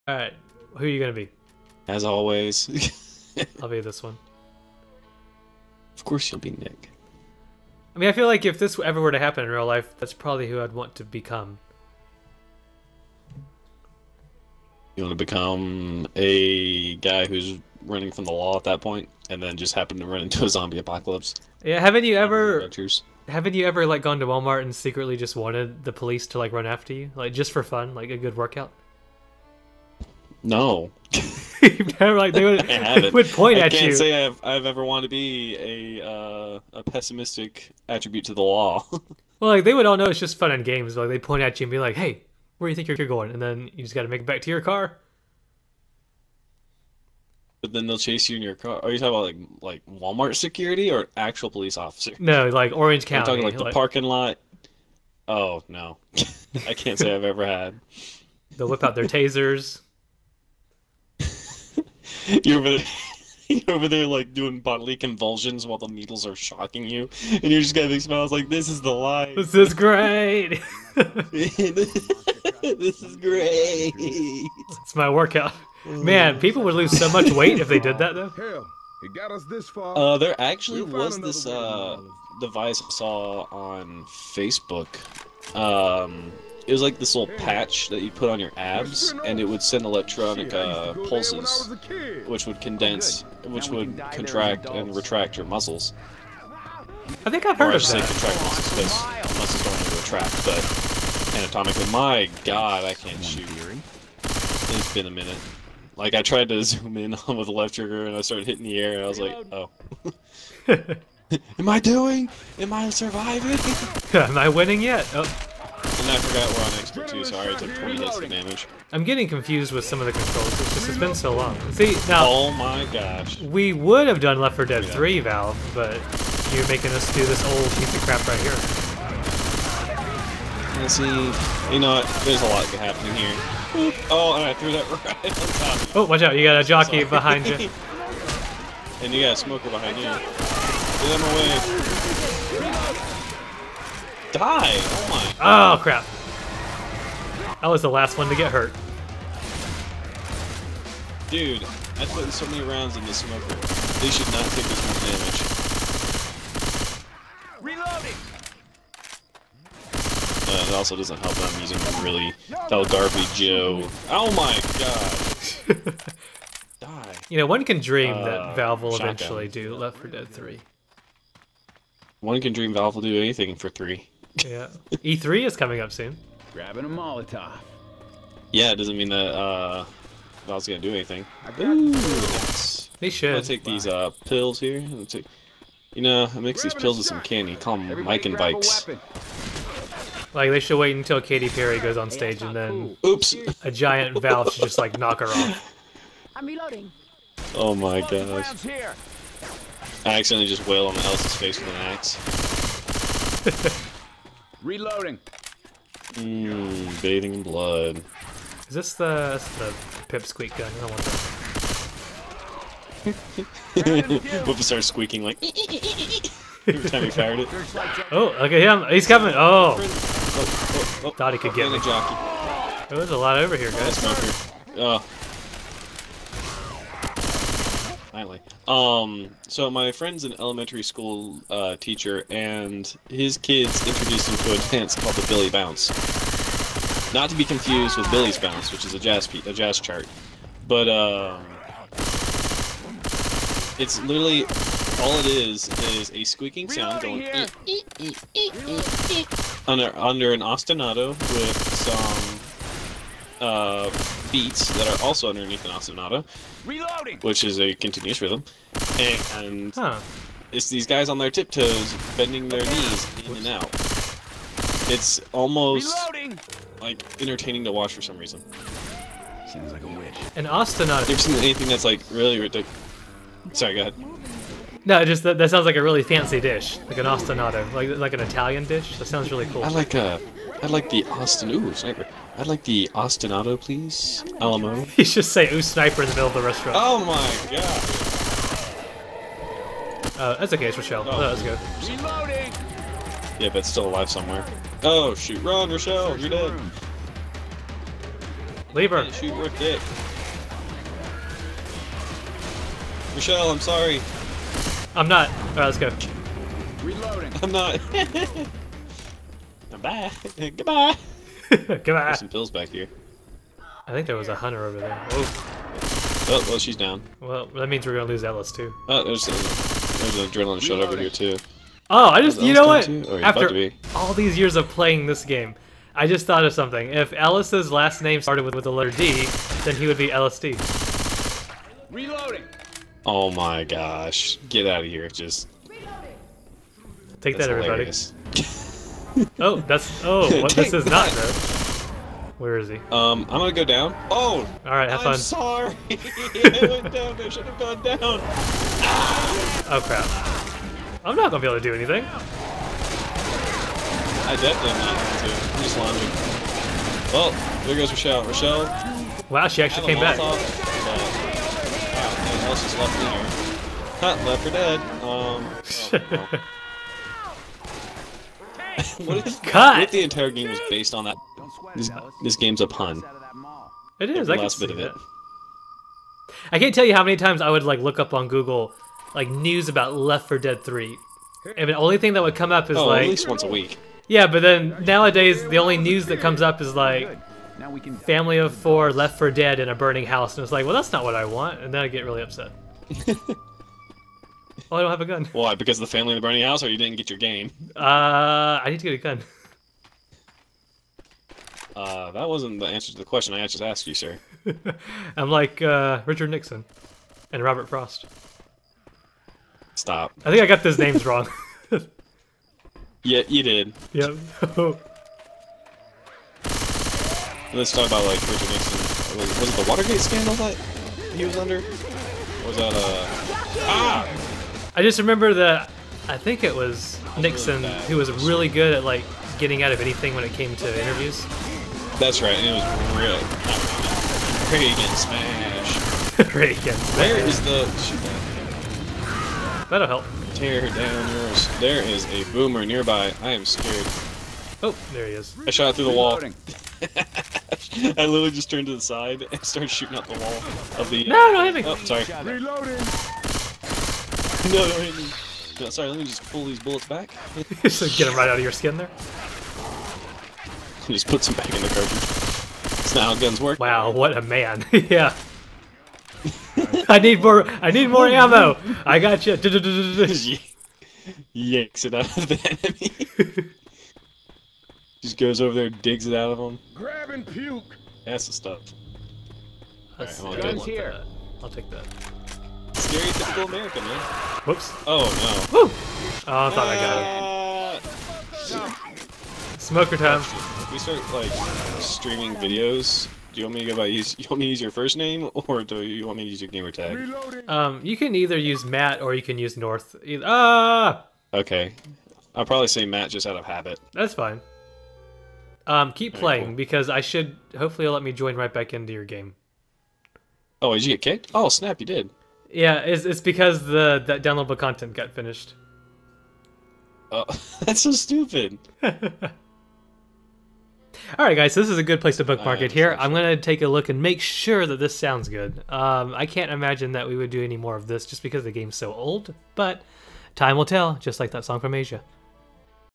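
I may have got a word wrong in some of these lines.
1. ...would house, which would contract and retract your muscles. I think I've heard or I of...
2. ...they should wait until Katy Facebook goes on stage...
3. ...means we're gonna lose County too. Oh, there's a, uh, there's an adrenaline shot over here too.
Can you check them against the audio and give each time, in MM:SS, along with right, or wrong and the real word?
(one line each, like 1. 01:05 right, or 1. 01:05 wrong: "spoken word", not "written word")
1. 01:32 wrong: "condense", not "house"
2. 03:10 wrong: "Perry", not "Facebook"
3. 05:17 wrong: "Ellis", not "County".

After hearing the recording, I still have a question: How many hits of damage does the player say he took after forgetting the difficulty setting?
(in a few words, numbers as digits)
20.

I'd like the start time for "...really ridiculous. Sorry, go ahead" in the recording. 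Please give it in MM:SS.
04:32.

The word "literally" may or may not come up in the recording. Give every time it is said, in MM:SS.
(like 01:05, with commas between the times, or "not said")
04:04, 07:28.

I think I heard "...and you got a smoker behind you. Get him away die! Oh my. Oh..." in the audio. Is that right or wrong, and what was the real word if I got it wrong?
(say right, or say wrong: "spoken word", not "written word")
right.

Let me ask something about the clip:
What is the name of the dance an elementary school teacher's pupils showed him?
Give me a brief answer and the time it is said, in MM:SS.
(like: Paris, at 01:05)
Billy Bounce, at 03:55.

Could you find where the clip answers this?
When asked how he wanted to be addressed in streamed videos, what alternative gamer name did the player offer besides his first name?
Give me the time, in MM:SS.
08:19.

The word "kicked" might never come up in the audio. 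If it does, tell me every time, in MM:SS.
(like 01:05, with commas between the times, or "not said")
08:31.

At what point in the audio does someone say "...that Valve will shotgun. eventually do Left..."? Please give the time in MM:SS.
02:48.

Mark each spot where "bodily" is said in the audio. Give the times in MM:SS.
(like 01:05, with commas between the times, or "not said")
01:04.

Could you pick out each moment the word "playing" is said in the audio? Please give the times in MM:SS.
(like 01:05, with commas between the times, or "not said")
05:24, 08:26.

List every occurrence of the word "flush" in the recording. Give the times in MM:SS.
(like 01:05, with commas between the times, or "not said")
not said.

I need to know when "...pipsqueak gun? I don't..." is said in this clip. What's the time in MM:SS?
03:30.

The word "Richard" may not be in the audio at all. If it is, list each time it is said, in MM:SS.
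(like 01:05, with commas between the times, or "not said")
06:46, 06:58.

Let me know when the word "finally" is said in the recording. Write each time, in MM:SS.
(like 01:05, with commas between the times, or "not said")
03:48.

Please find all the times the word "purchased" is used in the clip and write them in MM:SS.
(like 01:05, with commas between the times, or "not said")
not said.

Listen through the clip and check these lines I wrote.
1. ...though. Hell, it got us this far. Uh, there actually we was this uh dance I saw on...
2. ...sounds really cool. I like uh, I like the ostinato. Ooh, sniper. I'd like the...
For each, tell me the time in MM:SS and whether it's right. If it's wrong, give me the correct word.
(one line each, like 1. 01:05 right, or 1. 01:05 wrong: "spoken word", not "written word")
1. 01:18 wrong: "device", not "dance"
2. 04:39 right.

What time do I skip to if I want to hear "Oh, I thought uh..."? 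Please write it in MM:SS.
08:06.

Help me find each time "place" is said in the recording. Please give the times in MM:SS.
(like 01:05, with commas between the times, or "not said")
08:41.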